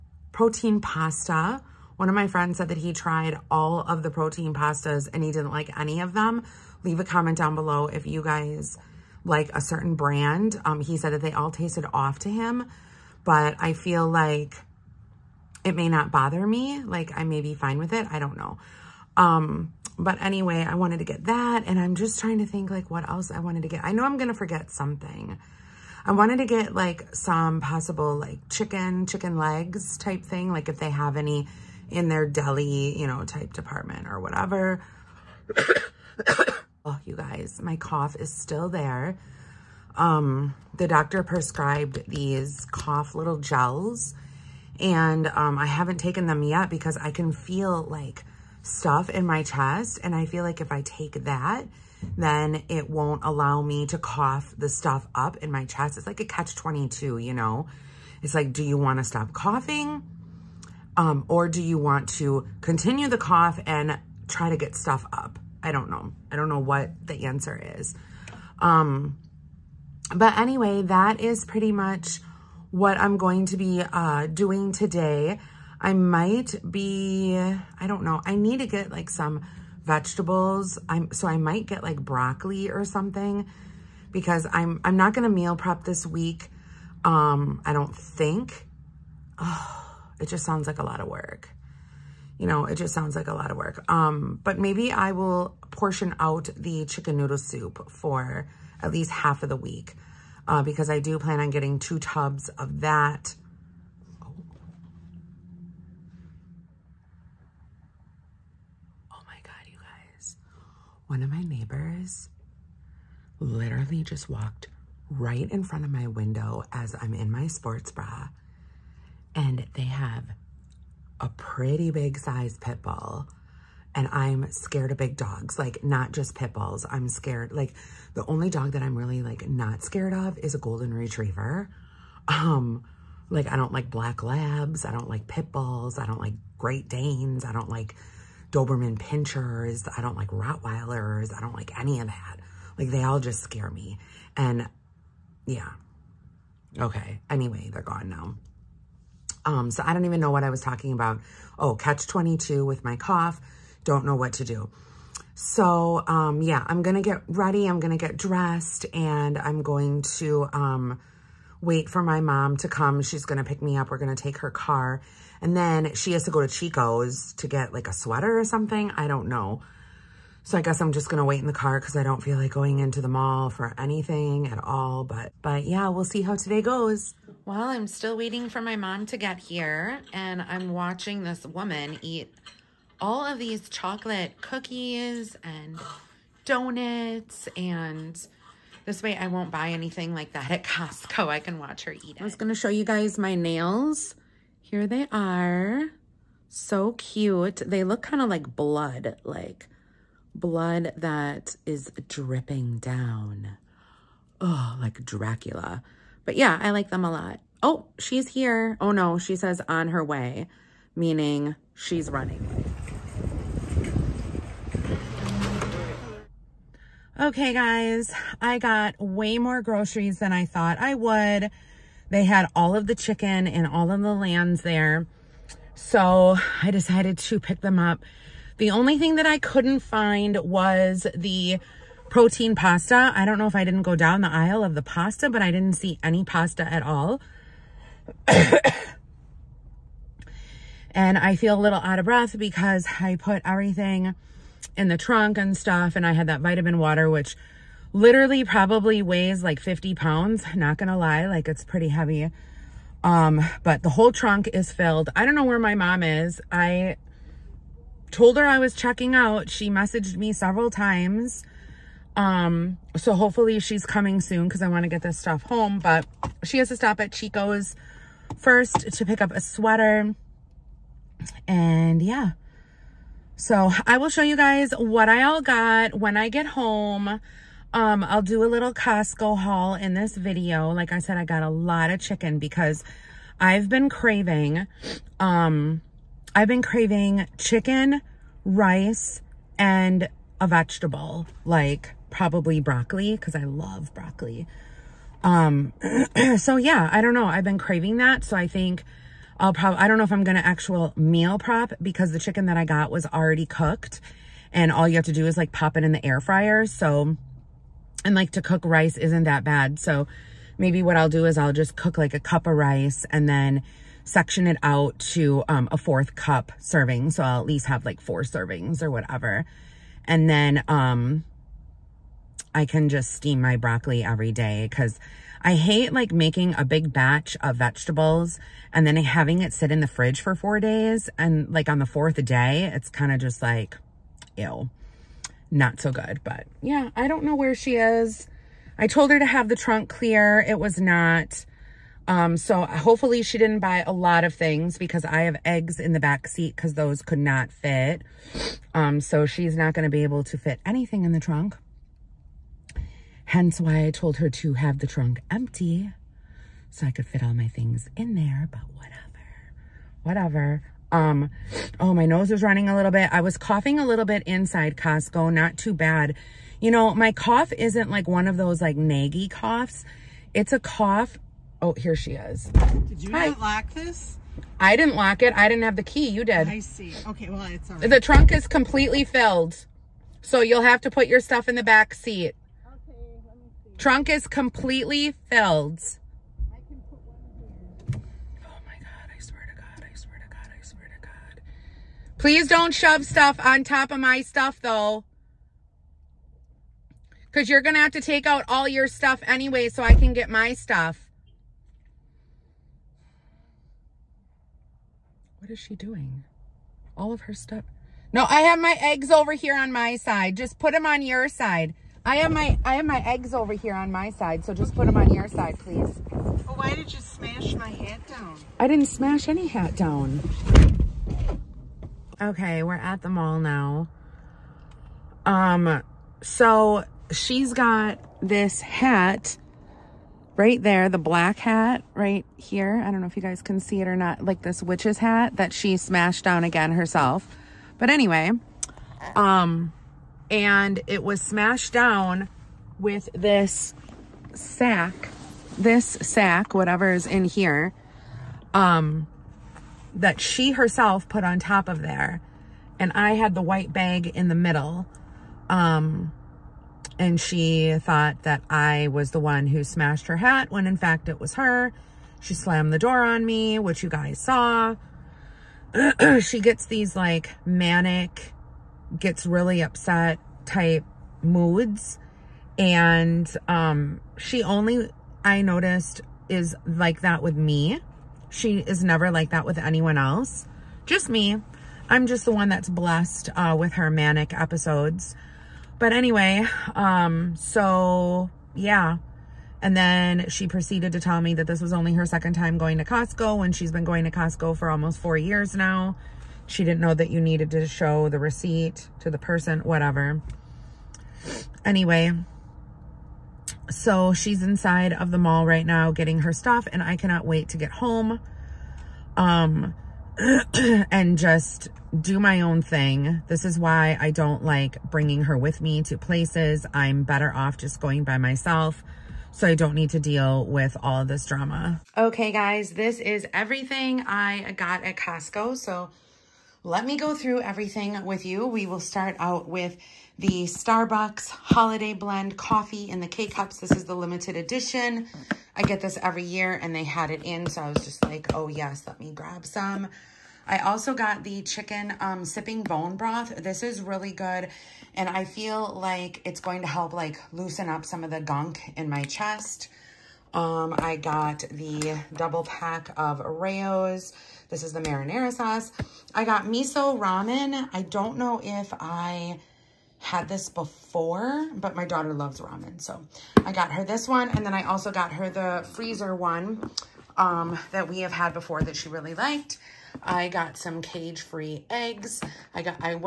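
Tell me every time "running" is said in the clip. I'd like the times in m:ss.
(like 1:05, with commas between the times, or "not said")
3:32, 6:02.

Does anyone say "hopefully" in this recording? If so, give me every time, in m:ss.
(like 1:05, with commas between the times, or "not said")
4:23, 5:42.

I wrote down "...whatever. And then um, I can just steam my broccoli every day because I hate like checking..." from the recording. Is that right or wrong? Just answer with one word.
wrong.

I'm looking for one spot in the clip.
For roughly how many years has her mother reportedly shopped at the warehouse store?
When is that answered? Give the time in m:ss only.
8:14.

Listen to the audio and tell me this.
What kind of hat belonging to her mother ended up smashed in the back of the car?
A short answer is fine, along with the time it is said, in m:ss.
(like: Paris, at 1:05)
witch's hat, at 7:14.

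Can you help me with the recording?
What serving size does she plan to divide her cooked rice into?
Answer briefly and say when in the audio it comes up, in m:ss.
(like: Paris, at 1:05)
a fourth cup, at 5:15.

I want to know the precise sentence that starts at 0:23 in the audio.
I know I'm going to forget something.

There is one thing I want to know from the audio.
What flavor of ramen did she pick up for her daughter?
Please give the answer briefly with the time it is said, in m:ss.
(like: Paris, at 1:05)
miso, at 9:16.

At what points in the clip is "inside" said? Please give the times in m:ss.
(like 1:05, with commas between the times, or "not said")
6:04, 8:24.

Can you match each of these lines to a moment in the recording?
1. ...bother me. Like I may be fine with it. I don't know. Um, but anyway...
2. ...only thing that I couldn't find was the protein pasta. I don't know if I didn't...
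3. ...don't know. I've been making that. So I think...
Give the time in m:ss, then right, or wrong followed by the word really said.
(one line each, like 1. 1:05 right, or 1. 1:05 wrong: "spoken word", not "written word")
1. 0:16 right
2. 3:48 right
3. 4:57 wrong: "craving", not "making".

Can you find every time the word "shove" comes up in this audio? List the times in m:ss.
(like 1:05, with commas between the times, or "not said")
6:32.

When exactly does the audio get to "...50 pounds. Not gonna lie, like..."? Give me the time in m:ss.
4:09.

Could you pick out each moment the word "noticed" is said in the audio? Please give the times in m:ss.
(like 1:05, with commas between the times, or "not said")
7:55.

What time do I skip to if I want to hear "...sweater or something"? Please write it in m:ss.
2:47.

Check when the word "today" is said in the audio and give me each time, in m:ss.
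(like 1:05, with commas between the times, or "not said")
1:14, 2:56.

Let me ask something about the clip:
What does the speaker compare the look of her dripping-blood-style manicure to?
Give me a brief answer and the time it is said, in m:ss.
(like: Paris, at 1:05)
Dracula, at 3:25.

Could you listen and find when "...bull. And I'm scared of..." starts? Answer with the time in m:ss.
2:02.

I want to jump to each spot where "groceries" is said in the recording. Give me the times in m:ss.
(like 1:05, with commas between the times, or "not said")
3:39.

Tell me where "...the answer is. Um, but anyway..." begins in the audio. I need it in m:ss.
1:07.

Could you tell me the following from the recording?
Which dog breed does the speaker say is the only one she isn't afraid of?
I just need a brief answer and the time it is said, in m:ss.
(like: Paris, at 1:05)
golden retriever, at 2:10.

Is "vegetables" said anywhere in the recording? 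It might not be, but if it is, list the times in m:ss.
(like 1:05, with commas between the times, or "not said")
1:19, 4:50, 5:27.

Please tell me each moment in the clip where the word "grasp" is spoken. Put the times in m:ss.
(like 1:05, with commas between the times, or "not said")
not said.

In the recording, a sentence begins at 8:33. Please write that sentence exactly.
This is why I don't like bringing her with me to places.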